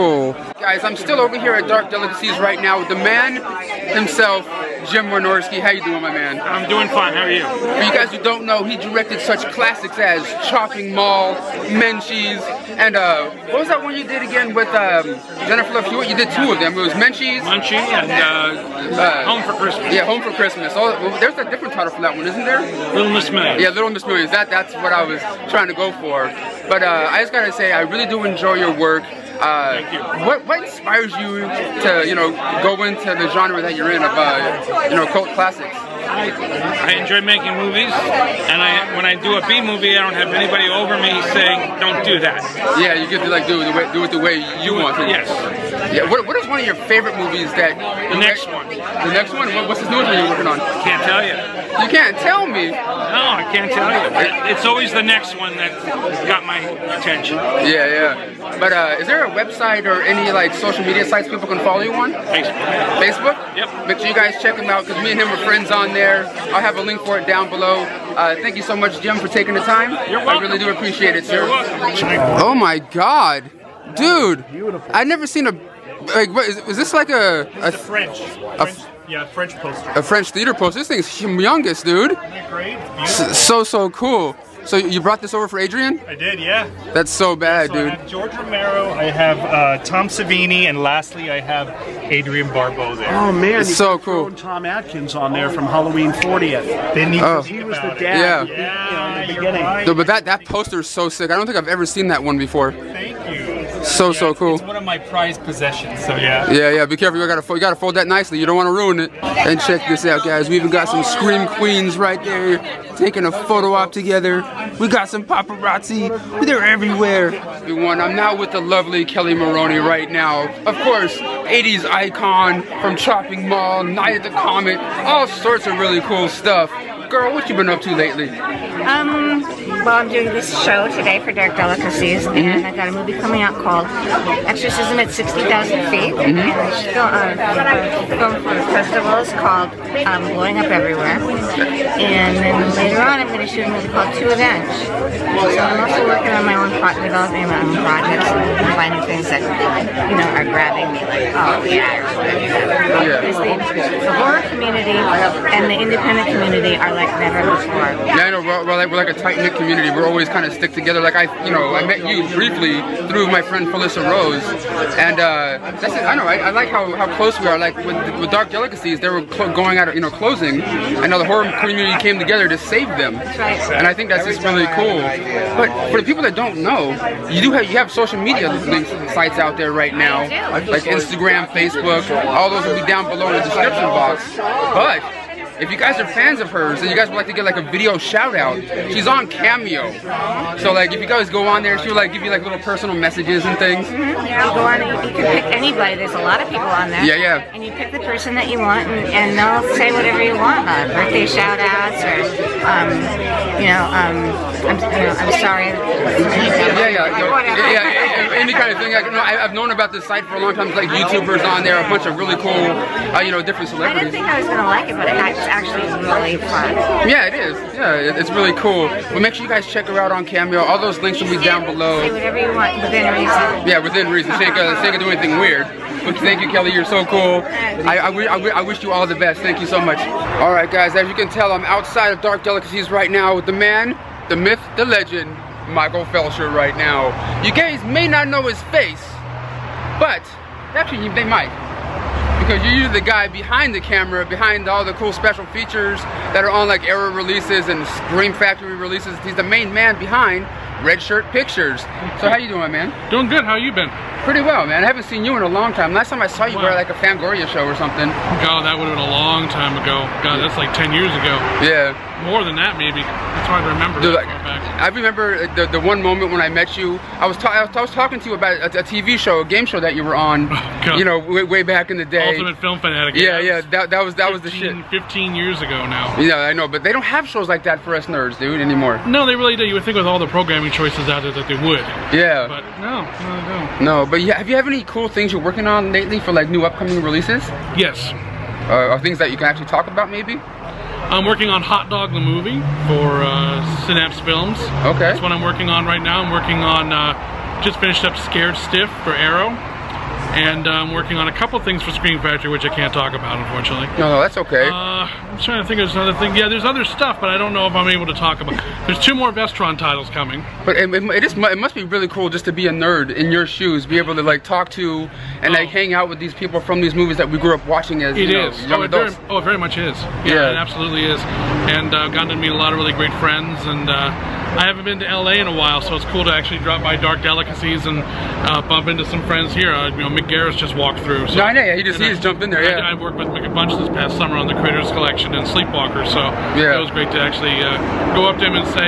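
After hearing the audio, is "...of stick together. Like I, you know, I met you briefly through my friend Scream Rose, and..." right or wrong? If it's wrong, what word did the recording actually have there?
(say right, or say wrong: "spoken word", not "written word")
wrong: "Felissa", not "Scream".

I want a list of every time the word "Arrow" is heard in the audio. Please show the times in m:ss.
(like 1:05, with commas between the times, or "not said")
4:06, 4:59.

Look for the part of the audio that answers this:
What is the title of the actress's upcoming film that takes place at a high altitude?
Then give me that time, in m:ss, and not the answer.
2:14.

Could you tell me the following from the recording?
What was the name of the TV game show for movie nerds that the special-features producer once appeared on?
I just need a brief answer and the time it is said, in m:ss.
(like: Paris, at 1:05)
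Ultimate Film Fanatic, at 4:32.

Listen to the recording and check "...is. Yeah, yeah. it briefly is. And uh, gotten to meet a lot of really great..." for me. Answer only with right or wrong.
wrong.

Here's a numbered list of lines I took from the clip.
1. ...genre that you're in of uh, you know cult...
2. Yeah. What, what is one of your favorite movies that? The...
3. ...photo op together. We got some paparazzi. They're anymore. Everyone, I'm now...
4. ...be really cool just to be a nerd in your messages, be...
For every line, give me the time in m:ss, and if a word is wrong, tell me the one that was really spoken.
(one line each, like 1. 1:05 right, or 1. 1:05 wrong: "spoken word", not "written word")
1. 0:33 right
2. 0:45 right
3. 1:53 wrong: "everywhere", not "anymore"
4. 5:11 wrong: "shoes", not "messages".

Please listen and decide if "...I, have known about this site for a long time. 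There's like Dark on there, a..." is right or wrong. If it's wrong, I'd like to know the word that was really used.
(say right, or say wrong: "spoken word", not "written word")
wrong: "YouTubers", not "Dark".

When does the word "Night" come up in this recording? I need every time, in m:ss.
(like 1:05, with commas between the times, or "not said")
2:03.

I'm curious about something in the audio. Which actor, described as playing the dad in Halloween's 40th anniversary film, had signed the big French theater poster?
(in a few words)
Tom Atkins.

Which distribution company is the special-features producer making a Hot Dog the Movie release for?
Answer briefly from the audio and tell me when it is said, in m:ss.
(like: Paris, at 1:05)
Synapse Films, at 4:53.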